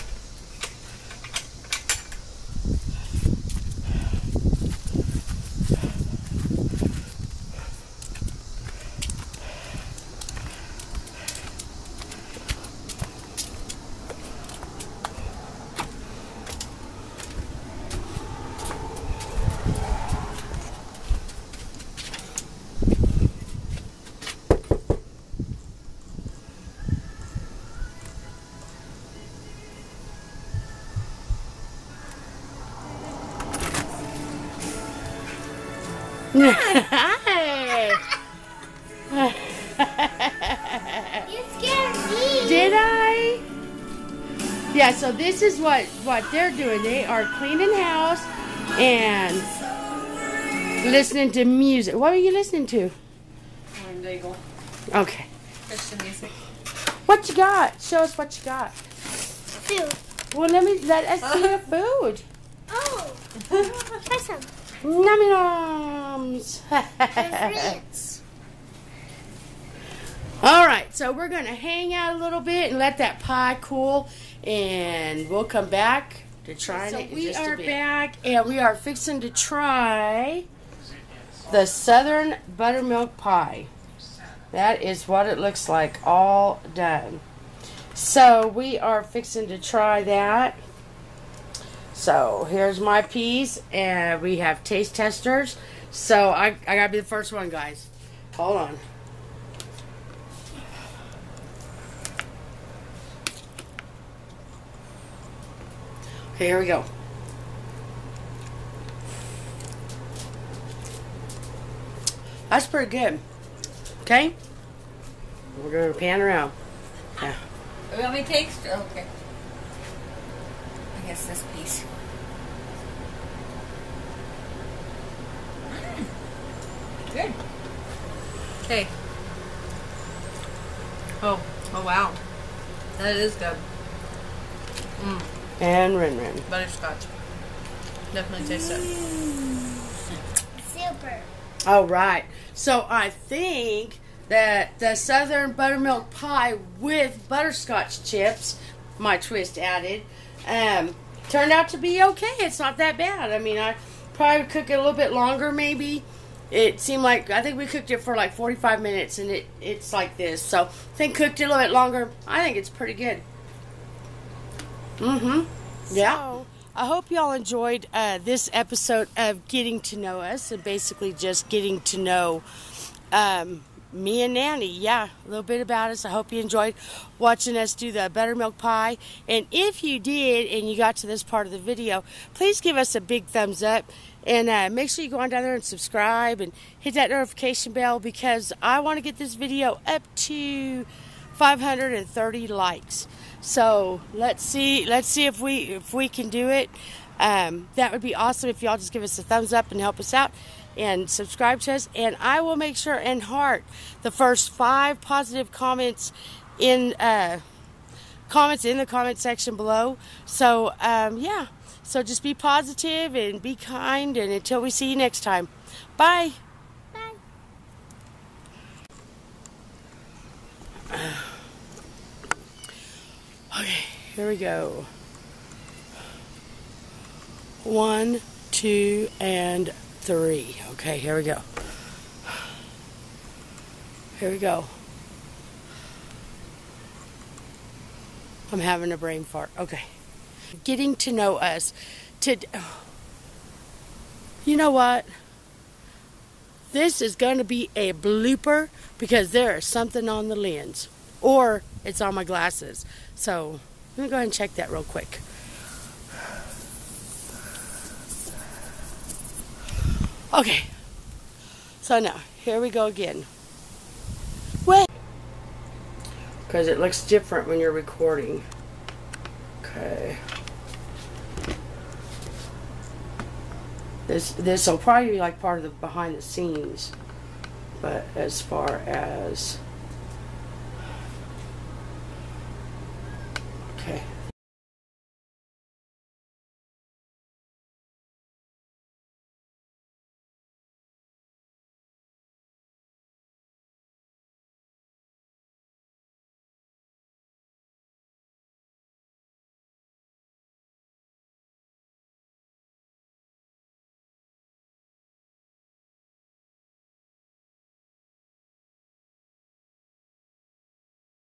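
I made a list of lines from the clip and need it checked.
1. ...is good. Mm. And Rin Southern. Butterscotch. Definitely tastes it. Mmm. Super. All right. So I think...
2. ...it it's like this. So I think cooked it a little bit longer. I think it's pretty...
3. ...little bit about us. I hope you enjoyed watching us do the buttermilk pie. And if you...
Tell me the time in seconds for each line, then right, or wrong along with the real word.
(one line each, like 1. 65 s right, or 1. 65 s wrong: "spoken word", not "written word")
1. 133 s wrong: "Rin", not "Southern"
2. 159 s right
3. 175 s right.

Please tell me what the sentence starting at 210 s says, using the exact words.
So um, yeah, so just be positive and be kind.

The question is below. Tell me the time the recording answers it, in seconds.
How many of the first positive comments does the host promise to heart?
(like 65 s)
204 s.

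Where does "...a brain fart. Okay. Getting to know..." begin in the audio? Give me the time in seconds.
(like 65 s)
238 s.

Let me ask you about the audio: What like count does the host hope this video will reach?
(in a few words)
530.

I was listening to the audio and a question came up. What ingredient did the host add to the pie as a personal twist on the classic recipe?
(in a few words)
Butterscotch chips.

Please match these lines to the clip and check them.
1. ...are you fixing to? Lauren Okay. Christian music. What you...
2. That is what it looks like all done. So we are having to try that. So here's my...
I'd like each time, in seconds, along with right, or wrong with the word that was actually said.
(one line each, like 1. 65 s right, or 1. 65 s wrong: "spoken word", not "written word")
1. 52 s wrong: "listening", not "fixing"
2. 84 s wrong: "fixing", not "having".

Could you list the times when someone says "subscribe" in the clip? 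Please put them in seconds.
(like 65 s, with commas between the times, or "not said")
185 s, 201 s.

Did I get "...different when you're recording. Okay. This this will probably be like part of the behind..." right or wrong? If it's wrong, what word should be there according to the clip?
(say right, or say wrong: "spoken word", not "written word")
right.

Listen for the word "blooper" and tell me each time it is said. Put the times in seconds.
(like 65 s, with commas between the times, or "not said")
247 s.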